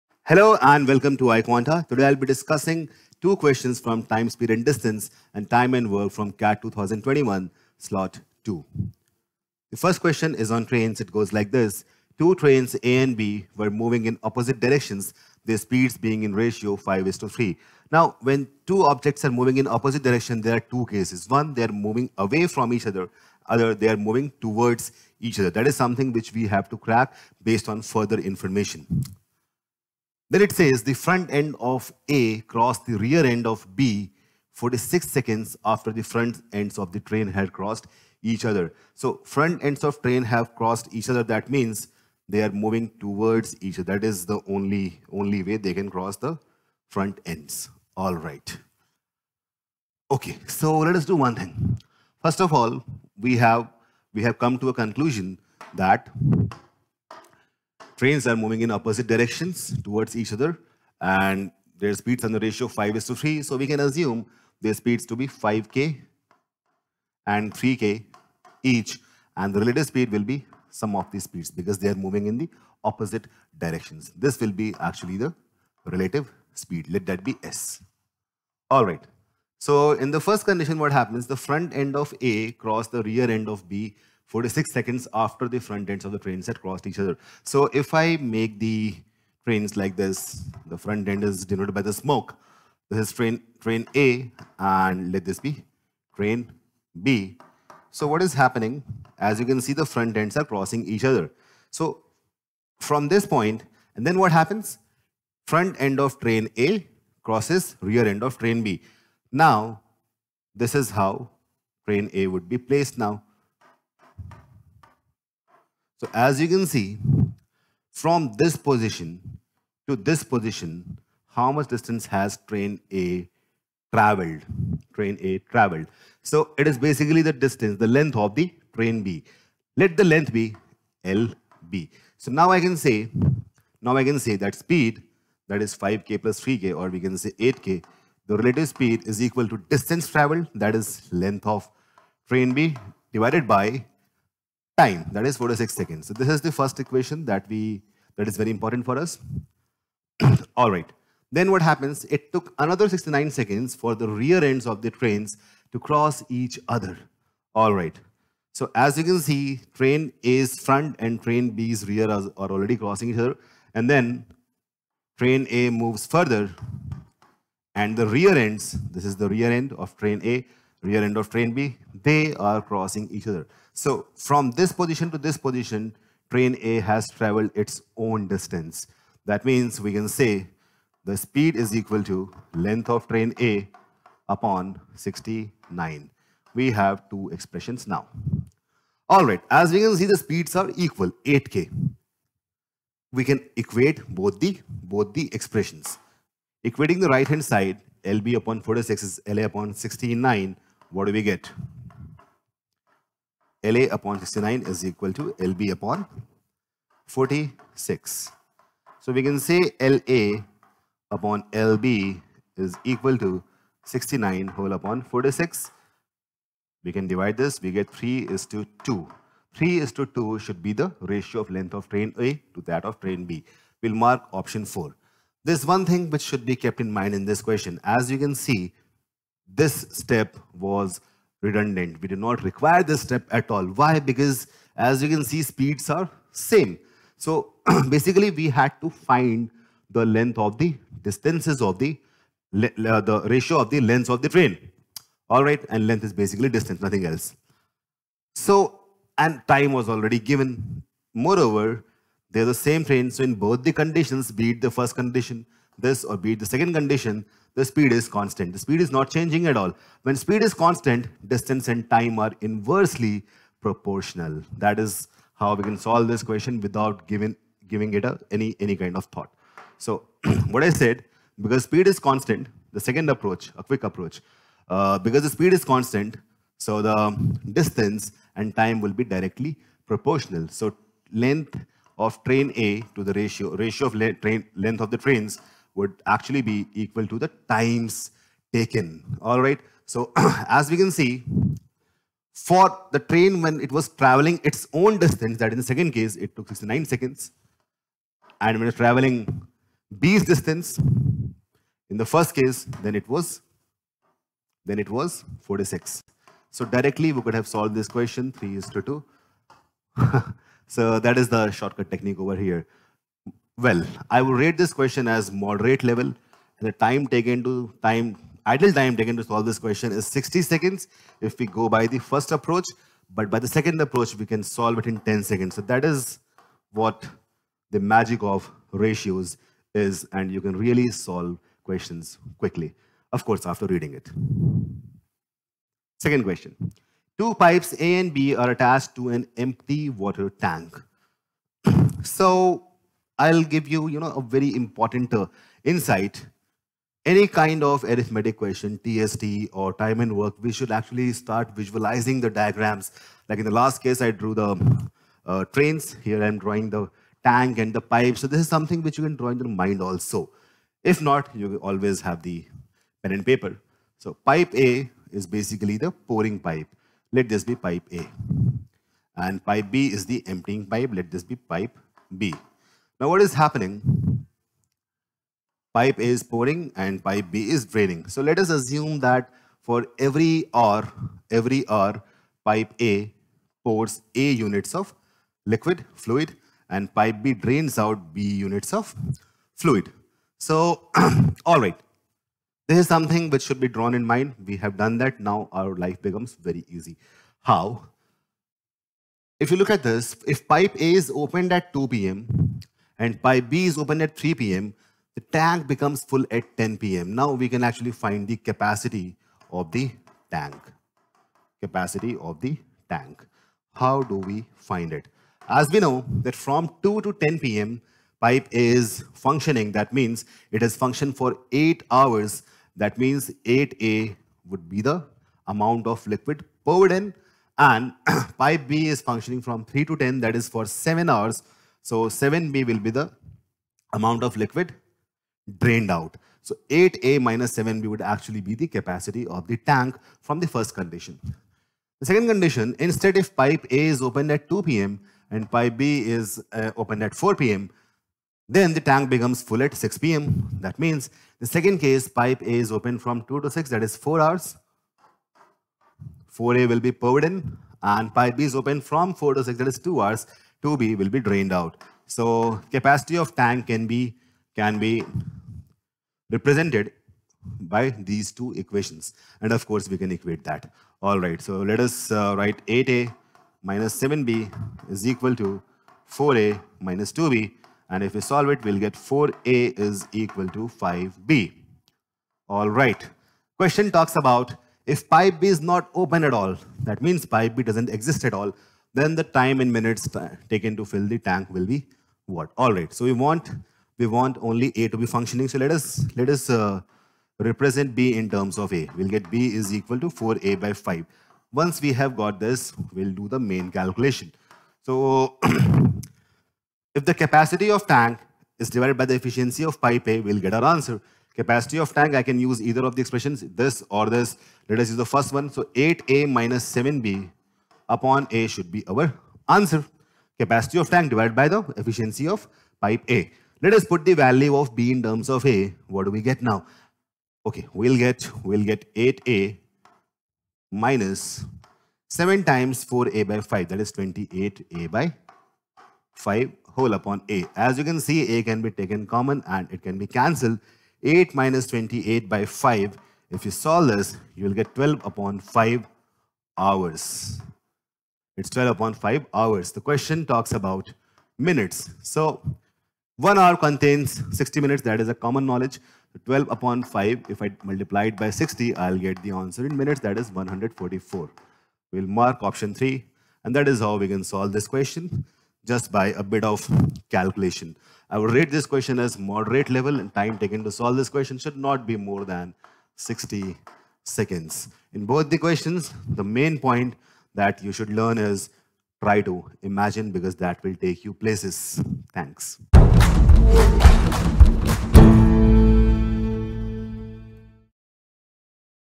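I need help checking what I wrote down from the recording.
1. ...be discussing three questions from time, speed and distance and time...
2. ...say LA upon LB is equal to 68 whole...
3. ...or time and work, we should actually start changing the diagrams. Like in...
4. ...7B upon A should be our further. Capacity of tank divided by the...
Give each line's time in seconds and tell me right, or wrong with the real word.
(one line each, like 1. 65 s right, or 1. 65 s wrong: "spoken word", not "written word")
1. 2 s wrong: "two", not "three"
2. 209 s wrong: "69", not "68"
3. 349 s wrong: "visualizing", not "changing"
4. 516 s wrong: "answer", not "further".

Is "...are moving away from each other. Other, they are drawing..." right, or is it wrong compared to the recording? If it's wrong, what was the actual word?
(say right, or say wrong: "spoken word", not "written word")
wrong: "moving", not "drawing".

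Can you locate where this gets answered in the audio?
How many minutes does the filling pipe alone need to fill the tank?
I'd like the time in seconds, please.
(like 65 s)
560 s.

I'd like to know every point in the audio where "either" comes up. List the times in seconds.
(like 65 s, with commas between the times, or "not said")
512 s.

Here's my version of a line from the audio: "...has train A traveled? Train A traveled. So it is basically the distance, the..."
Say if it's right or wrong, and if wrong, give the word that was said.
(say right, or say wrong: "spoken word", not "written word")
right.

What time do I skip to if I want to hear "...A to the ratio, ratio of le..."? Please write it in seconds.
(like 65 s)
282 s.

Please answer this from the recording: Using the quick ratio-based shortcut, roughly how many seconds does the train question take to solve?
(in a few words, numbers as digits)
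10.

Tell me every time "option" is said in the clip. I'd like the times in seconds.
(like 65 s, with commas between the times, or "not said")
224 s, 562 s.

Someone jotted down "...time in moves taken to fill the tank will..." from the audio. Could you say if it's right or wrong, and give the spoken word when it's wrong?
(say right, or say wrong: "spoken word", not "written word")
wrong: "minutes", not "moves".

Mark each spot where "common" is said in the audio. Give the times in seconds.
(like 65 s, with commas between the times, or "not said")
539 s, 555 s.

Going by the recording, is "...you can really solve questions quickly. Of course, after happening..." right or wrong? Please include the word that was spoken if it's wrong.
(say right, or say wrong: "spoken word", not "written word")
wrong: "reading", not "happening".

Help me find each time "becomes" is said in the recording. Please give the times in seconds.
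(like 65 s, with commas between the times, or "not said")
396 s, 405 s, 449 s.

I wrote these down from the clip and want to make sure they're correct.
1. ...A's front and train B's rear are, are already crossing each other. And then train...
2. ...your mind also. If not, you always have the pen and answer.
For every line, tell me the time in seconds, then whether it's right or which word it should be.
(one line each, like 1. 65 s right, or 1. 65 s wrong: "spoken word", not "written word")
1. 160 s right
2. 359 s wrong: "paper", not "answer".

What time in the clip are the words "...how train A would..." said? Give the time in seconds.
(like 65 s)
110 s.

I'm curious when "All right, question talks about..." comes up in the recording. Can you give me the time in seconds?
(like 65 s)
482 s.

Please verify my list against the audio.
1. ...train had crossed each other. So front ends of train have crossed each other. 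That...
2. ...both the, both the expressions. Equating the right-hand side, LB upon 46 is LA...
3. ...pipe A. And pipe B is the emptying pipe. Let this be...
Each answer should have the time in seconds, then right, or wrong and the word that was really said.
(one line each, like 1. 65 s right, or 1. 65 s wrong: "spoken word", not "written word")
1. 37 s right
2. 194 s right
3. 367 s right.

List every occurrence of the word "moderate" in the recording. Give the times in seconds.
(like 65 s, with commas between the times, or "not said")
315 s, 569 s.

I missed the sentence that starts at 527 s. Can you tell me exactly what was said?
Okay, we'll get, we'll get 8A minus 7 times 4A by 5.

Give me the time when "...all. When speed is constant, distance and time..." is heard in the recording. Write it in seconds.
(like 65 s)
259 s.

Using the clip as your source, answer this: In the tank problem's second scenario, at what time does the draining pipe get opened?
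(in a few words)
4 p.m.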